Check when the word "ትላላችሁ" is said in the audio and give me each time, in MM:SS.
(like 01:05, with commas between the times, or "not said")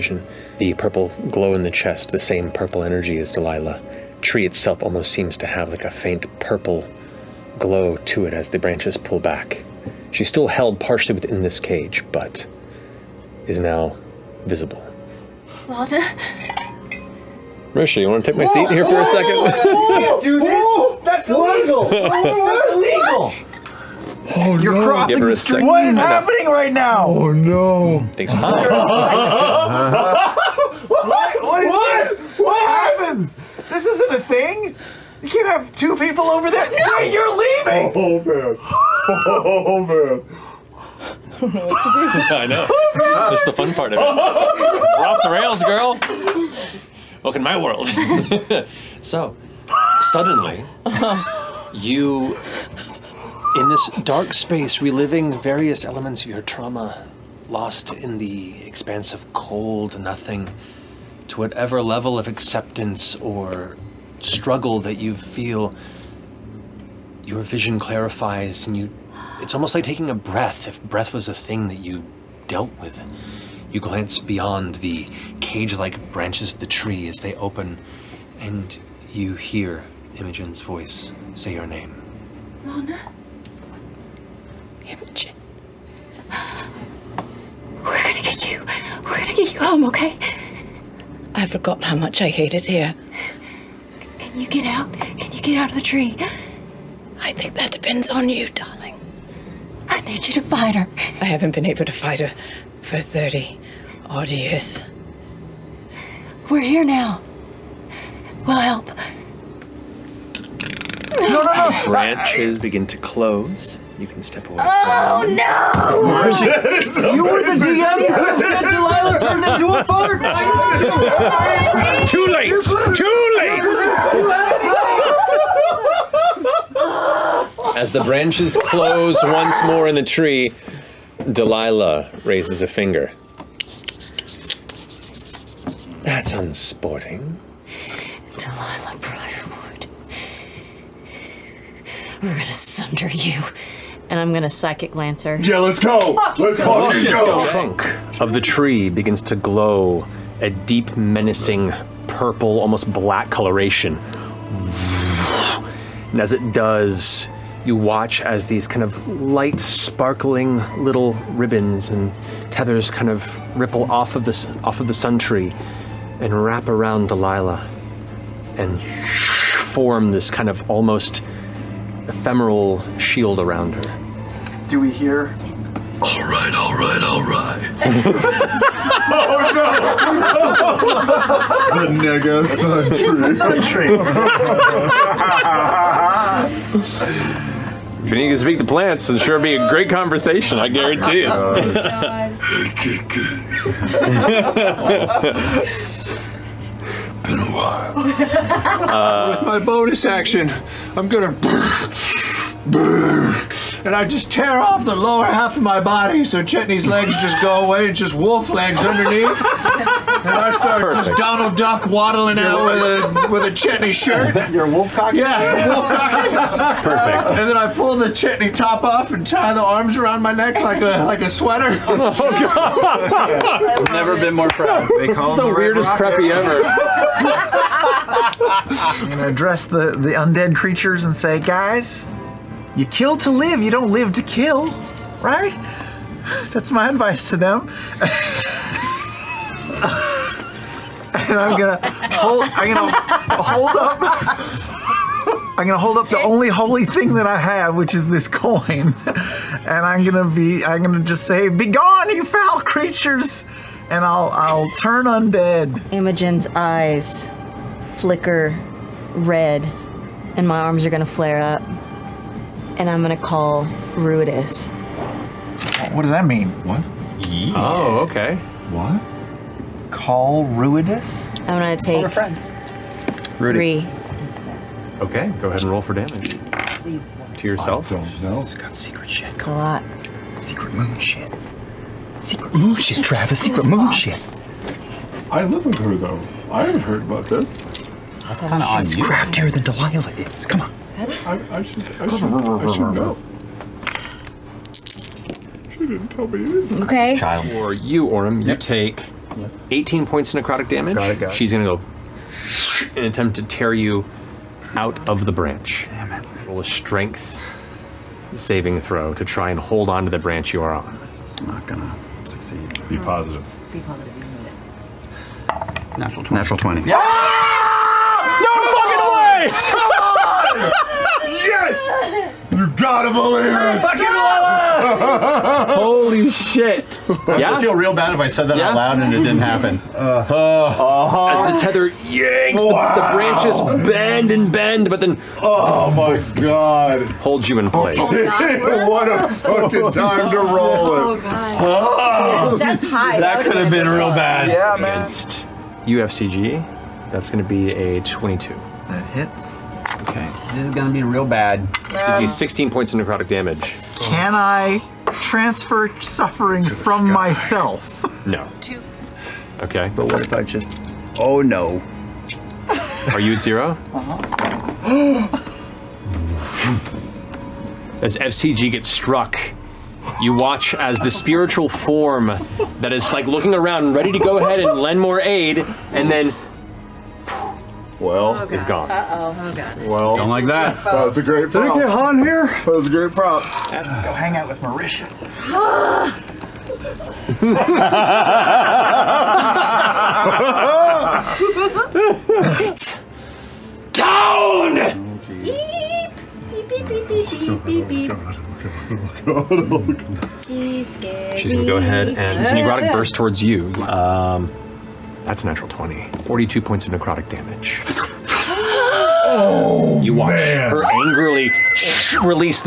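not said.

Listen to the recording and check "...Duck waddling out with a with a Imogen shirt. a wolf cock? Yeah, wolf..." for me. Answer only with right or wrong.
wrong.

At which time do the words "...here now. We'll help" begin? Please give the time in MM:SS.
01:46.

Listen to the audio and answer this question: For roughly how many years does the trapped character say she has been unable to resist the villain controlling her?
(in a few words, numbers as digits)
30.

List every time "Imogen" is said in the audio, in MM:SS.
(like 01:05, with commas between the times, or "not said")
01:20, 01:24, 04:15.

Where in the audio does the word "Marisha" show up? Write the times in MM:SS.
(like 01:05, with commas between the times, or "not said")
00:17, 06:24.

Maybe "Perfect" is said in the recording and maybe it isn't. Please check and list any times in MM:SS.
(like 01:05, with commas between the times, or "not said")
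03:30, 03:36.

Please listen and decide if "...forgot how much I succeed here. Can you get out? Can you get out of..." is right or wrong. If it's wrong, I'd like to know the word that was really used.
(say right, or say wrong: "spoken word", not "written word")
wrong: "hated", not "succeed".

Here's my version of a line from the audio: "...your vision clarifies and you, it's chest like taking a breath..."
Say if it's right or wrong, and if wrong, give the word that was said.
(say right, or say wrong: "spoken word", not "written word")
wrong: "almost", not "chest".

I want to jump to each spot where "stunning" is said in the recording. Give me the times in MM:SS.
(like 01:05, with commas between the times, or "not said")
not said.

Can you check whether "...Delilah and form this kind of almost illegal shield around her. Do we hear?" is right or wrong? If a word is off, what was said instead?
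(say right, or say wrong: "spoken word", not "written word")
wrong: "ephemeral", not "illegal".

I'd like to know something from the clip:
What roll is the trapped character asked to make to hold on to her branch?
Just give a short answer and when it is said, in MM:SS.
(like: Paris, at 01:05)
Strength saving throw, at 05:06.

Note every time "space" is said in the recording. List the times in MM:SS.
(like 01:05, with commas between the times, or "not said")
00:54.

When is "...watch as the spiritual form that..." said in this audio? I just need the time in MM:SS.
06:10.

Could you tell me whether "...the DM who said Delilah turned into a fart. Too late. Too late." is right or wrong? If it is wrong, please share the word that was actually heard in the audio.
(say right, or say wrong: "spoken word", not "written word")
right.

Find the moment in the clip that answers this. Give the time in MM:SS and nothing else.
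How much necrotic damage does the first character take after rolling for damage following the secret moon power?
04:59.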